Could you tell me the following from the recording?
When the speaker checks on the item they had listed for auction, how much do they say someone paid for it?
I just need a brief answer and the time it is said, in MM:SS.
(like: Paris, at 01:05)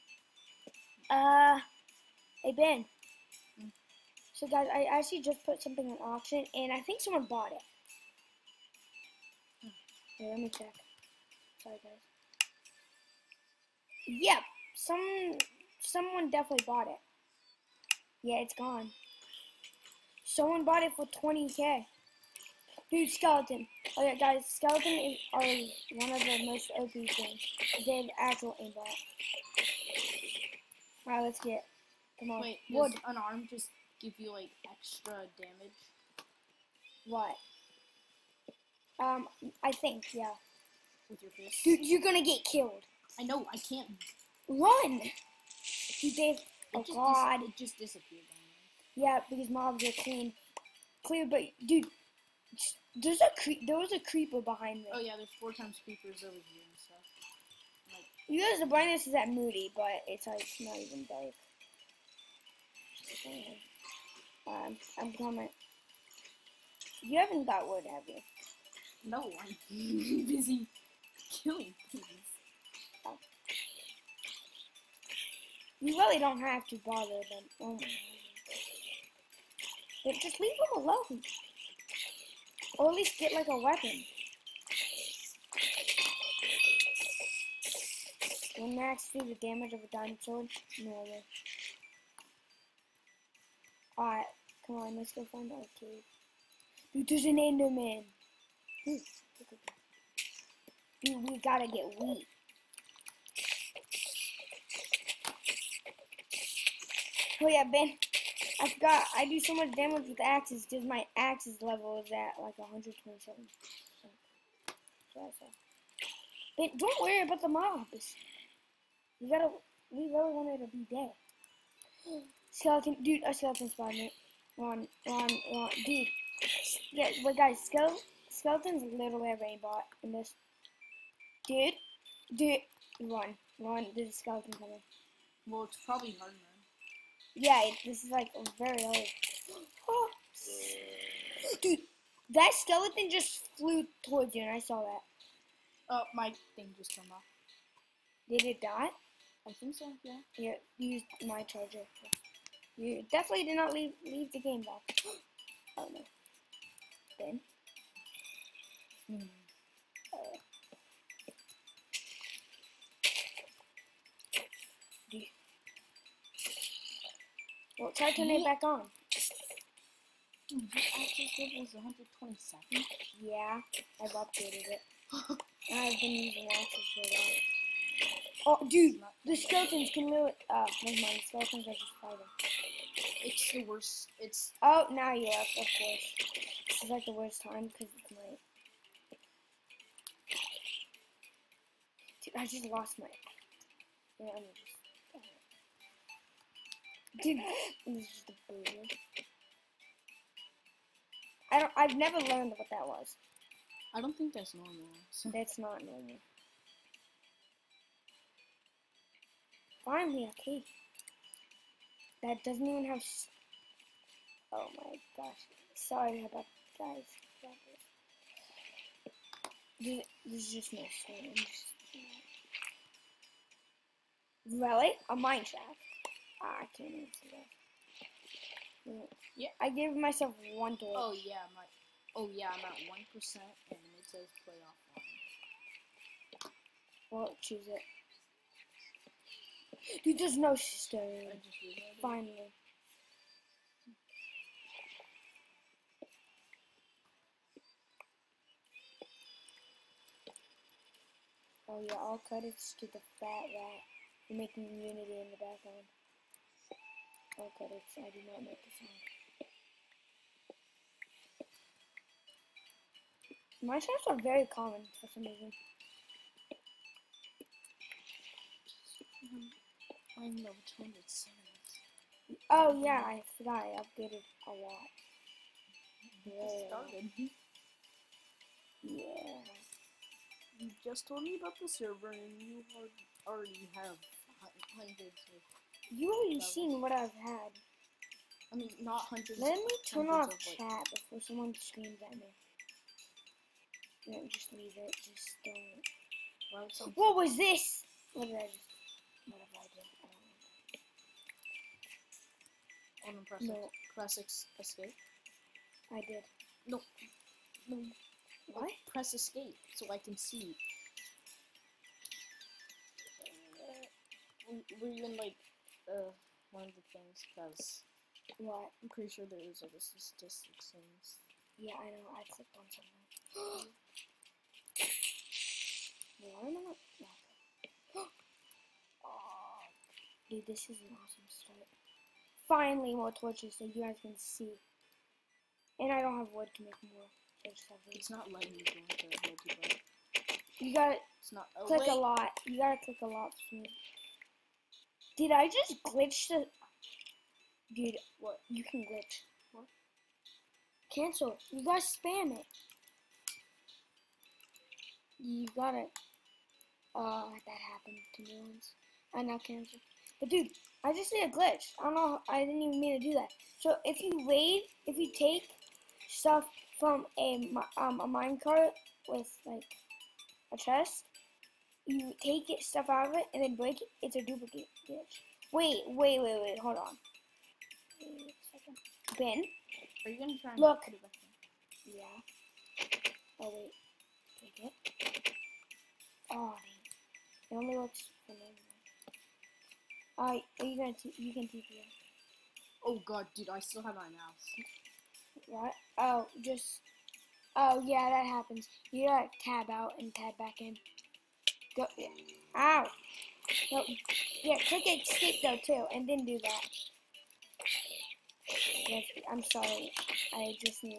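20k, at 00:21.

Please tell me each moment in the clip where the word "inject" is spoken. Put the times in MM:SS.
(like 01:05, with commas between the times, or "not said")
not said.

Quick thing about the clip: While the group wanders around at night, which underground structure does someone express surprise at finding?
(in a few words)
A mine shaft.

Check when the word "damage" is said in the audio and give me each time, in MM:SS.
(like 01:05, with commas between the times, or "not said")
00:35, 01:29, 01:49.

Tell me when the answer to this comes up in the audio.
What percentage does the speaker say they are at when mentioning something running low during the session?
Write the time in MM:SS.
03:52.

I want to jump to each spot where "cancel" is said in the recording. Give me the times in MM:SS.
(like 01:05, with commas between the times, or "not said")
05:50, 05:59.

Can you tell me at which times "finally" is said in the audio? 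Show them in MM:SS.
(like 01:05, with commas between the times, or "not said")
03:29, 04:02, 05:32.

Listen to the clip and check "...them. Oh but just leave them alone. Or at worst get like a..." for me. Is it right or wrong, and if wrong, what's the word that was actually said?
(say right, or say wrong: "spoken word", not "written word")
wrong: "least", not "worst".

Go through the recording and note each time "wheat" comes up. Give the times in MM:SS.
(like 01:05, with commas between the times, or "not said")
01:41.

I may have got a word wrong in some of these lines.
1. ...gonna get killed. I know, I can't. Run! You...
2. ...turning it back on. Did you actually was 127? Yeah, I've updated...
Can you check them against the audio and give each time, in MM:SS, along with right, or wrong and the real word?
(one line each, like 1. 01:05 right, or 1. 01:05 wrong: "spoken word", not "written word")
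1. 00:42 right
2. 02:48 right.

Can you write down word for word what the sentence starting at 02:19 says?
Oh, dude, that skeleton just flew towards you, and I saw that.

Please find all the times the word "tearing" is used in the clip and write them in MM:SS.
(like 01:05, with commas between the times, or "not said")
not said.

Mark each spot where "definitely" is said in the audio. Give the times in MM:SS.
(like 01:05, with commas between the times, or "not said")
00:16, 02:33.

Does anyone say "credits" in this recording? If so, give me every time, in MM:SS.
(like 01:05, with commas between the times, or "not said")
04:12, 04:17.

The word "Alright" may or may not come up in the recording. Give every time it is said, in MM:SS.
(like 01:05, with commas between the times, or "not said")
00:31, 01:33.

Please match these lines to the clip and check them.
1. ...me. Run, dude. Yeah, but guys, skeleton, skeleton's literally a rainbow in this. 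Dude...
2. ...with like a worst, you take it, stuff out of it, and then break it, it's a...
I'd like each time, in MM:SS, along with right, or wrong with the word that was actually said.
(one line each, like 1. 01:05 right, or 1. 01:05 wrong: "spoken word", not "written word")
1. 02:03 right
2. 06:09 wrong: "chest", not "worst".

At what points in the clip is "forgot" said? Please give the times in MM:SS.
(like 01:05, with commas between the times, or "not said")
01:48, 04:33.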